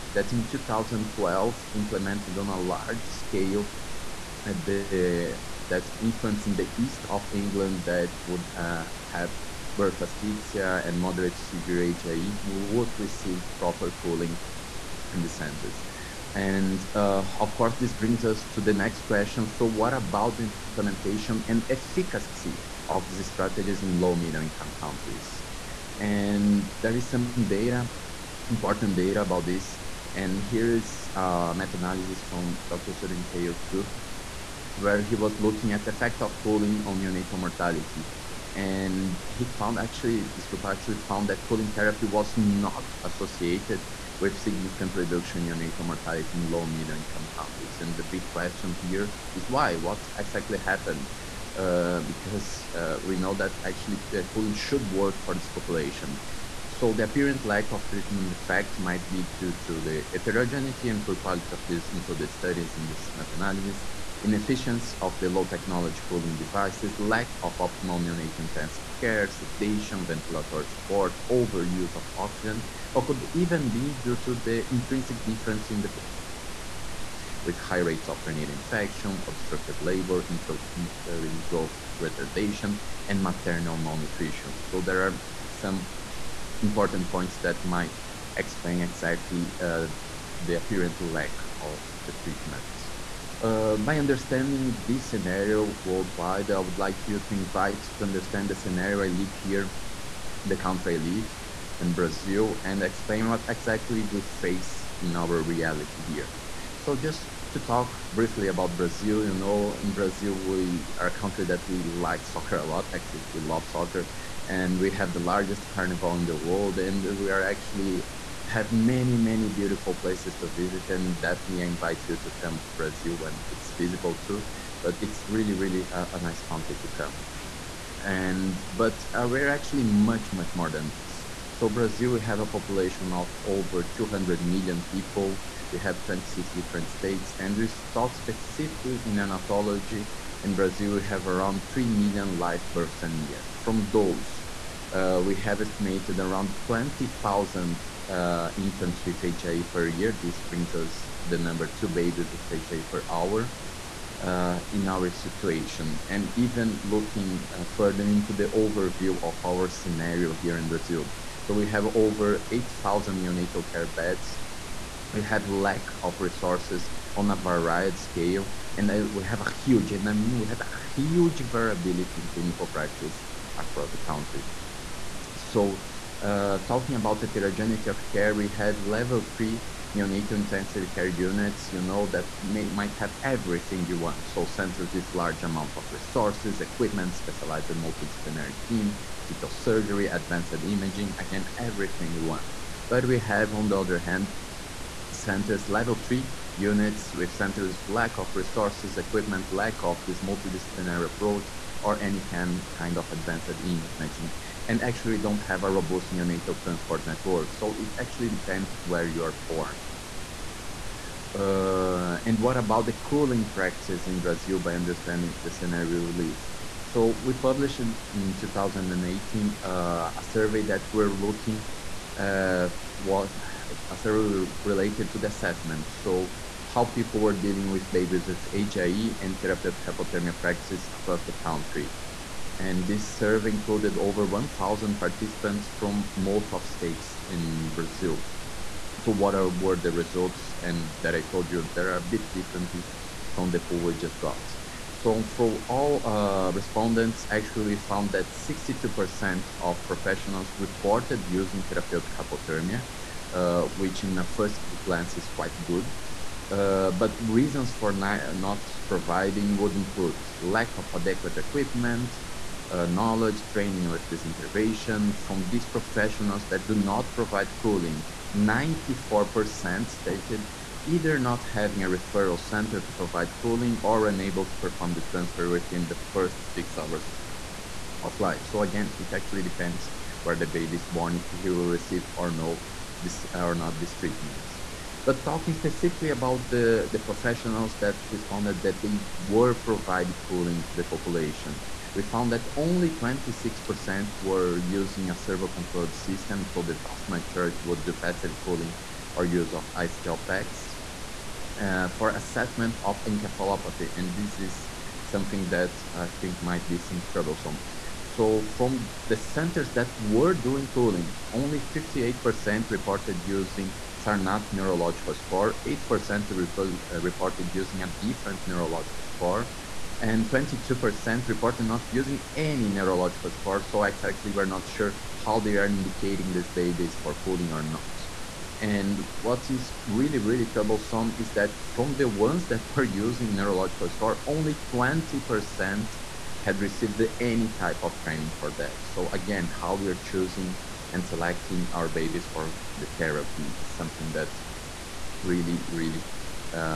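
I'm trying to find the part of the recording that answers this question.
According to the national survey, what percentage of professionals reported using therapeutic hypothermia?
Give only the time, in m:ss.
4:08.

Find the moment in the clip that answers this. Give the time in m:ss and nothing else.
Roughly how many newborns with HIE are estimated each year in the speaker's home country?
2:26.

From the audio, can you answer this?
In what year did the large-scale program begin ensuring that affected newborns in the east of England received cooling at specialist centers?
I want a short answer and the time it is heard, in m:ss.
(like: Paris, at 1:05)
2012, at 0:00.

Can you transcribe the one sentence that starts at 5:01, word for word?
Uh, for assessment of encephalopathy, and this is something that I think might be some troublesome.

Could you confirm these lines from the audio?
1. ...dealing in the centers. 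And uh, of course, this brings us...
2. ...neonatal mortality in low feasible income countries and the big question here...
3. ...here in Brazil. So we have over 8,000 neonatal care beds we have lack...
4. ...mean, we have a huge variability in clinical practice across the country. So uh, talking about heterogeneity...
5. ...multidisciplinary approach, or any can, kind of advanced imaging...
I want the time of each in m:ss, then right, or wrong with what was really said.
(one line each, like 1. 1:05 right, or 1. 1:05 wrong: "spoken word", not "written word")
1. 0:14 wrong: "cooling", not "dealing"
2. 0:45 wrong: "middle", not "feasible"
3. 2:40 right
4. 2:50 right
5. 3:20 right.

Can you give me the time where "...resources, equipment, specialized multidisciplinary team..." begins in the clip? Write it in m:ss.
3:05.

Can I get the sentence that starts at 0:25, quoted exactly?
And there is some data, important data about this.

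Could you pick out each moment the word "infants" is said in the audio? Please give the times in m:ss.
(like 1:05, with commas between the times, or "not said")
0:06, 2:28.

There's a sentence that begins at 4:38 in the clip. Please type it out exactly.
So again, it actually depends where the baby is born, if he will receive or no this or not this treatment.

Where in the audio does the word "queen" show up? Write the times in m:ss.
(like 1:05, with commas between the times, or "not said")
not said.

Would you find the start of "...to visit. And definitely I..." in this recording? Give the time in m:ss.
2:00.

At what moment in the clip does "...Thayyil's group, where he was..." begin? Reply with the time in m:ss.
0:33.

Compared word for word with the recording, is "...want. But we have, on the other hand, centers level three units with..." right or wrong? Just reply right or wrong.
right.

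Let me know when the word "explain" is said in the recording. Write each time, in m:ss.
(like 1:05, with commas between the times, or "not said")
1:28, 1:42.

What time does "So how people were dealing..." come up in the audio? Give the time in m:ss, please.
3:45.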